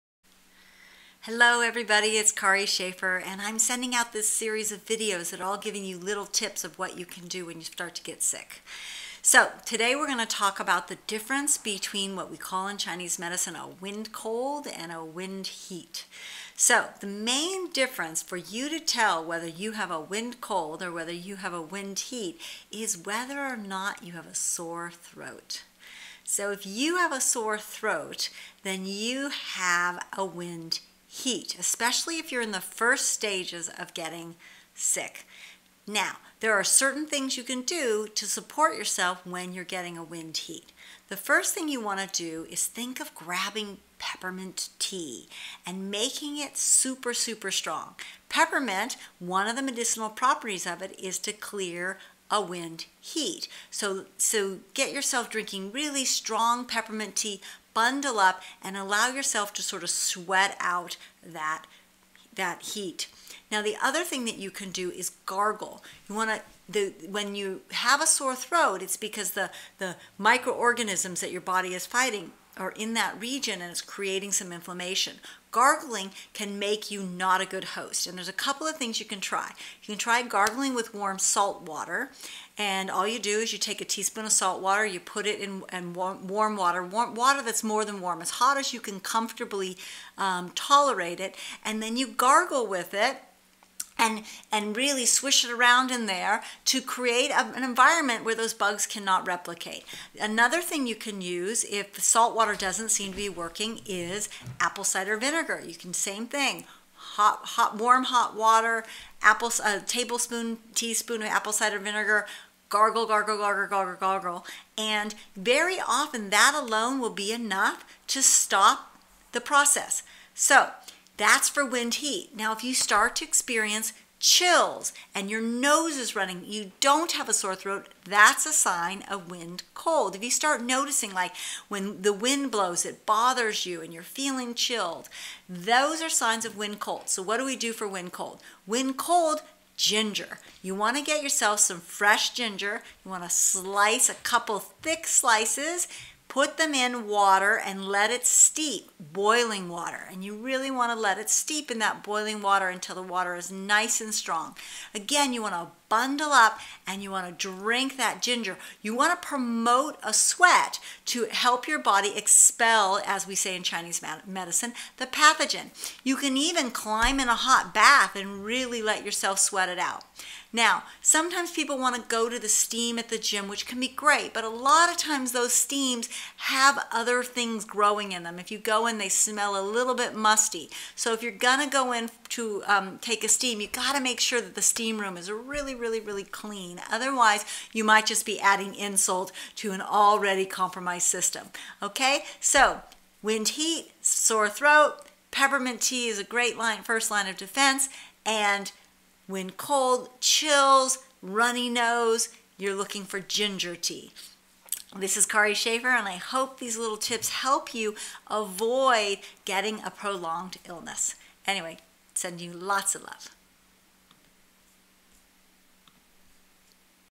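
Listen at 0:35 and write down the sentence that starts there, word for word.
Now, there are certain things you can do to support yourself when you're getting a wind heat.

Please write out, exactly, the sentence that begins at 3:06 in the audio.
Otherwise, you might just be adding insult to an already compromised system.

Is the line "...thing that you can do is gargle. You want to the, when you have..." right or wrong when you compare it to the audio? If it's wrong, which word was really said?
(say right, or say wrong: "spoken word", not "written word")
right.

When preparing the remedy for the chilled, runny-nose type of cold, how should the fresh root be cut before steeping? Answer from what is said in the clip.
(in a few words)
A couple thick slices.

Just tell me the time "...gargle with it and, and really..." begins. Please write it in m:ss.
1:32.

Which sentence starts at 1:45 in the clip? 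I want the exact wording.
You can, same thing, hot, hot, warm hot water, apple, a tablespoon, teaspoon of apple cider vinegar, gargle, gargle, gargle, gargle, gargle.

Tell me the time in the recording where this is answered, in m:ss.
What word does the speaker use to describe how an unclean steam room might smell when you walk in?
3:00.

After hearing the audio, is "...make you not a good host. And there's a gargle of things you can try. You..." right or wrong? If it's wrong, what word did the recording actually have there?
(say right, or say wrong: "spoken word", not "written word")
wrong: "couple", not "gargle".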